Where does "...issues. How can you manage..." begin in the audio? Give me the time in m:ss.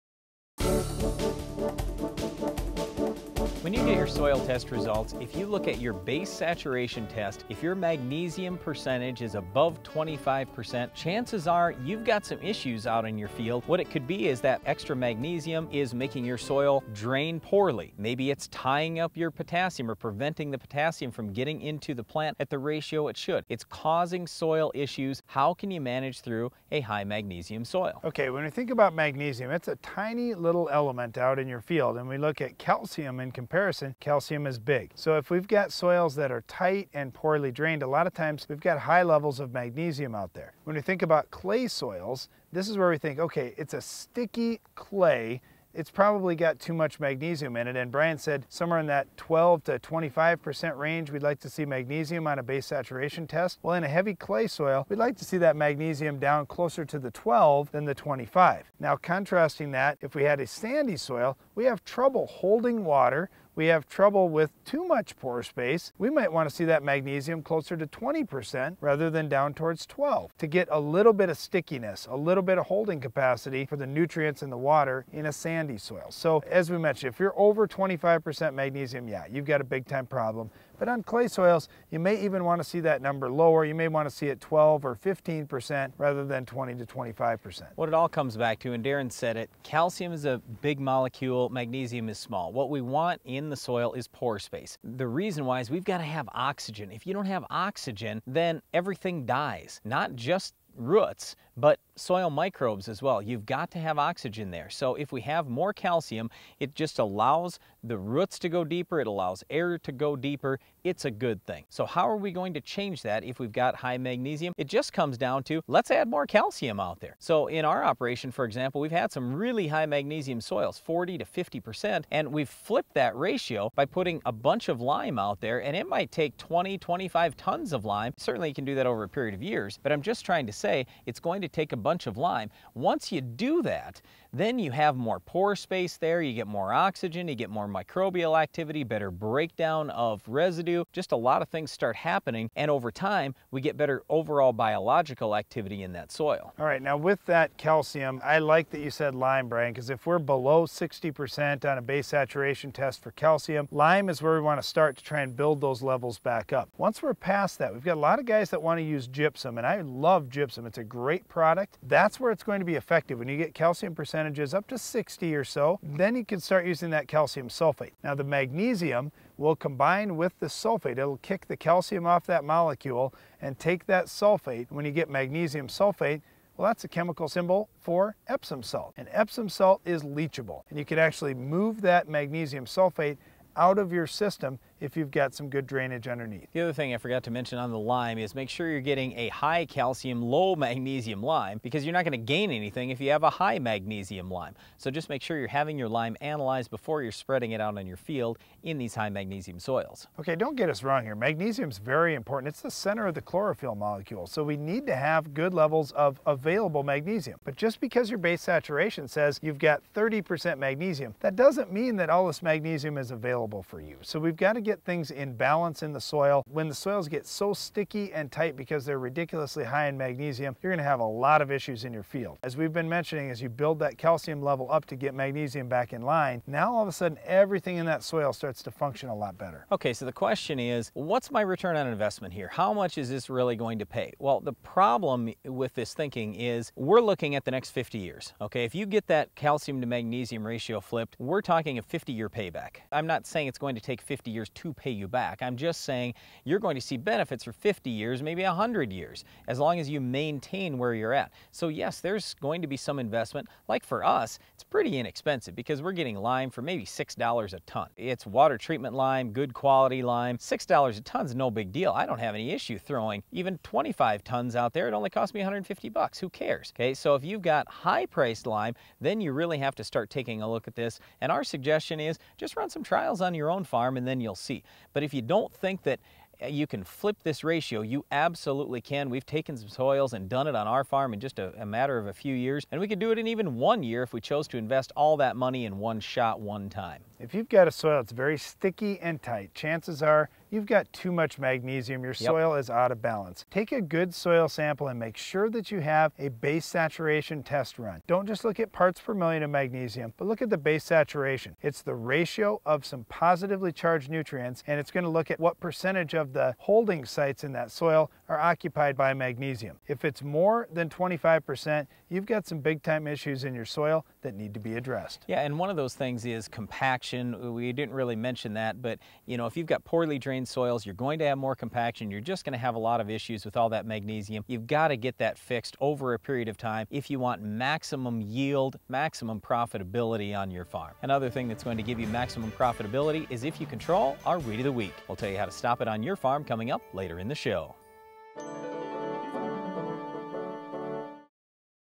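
0:24.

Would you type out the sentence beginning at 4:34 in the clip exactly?
But if you don't think that uh, you can flip this ratio.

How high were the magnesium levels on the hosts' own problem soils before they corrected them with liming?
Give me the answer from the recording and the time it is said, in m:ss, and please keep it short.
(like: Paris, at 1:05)
40 to 50%, at 2:00.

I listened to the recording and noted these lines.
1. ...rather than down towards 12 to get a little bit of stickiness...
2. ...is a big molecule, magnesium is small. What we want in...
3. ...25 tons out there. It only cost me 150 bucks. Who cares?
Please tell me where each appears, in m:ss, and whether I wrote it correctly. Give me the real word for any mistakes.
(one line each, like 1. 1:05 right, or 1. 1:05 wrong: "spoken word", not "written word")
1. 1:08 right
2. 1:30 right
3. 4:23 right.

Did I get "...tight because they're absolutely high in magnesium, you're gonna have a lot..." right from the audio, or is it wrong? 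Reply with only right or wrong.
wrong.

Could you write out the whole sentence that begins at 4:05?
I'm just saying you're going to see benefits for 50 years, maybe 100 years, as long as you maintain where you're at.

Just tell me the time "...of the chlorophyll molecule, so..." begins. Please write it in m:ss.
3:23.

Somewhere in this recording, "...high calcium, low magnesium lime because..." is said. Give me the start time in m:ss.
3:09.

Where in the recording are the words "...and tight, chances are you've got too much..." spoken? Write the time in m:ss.
4:49.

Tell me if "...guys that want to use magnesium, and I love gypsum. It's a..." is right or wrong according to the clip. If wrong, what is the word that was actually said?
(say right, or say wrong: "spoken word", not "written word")
wrong: "gypsum", not "magnesium".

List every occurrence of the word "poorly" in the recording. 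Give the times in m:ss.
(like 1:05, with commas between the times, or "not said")
0:17, 0:37, 5:19.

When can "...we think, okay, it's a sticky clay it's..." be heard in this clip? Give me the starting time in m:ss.
0:42.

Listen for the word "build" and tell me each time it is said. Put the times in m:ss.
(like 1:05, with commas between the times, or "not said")
2:35, 3:43.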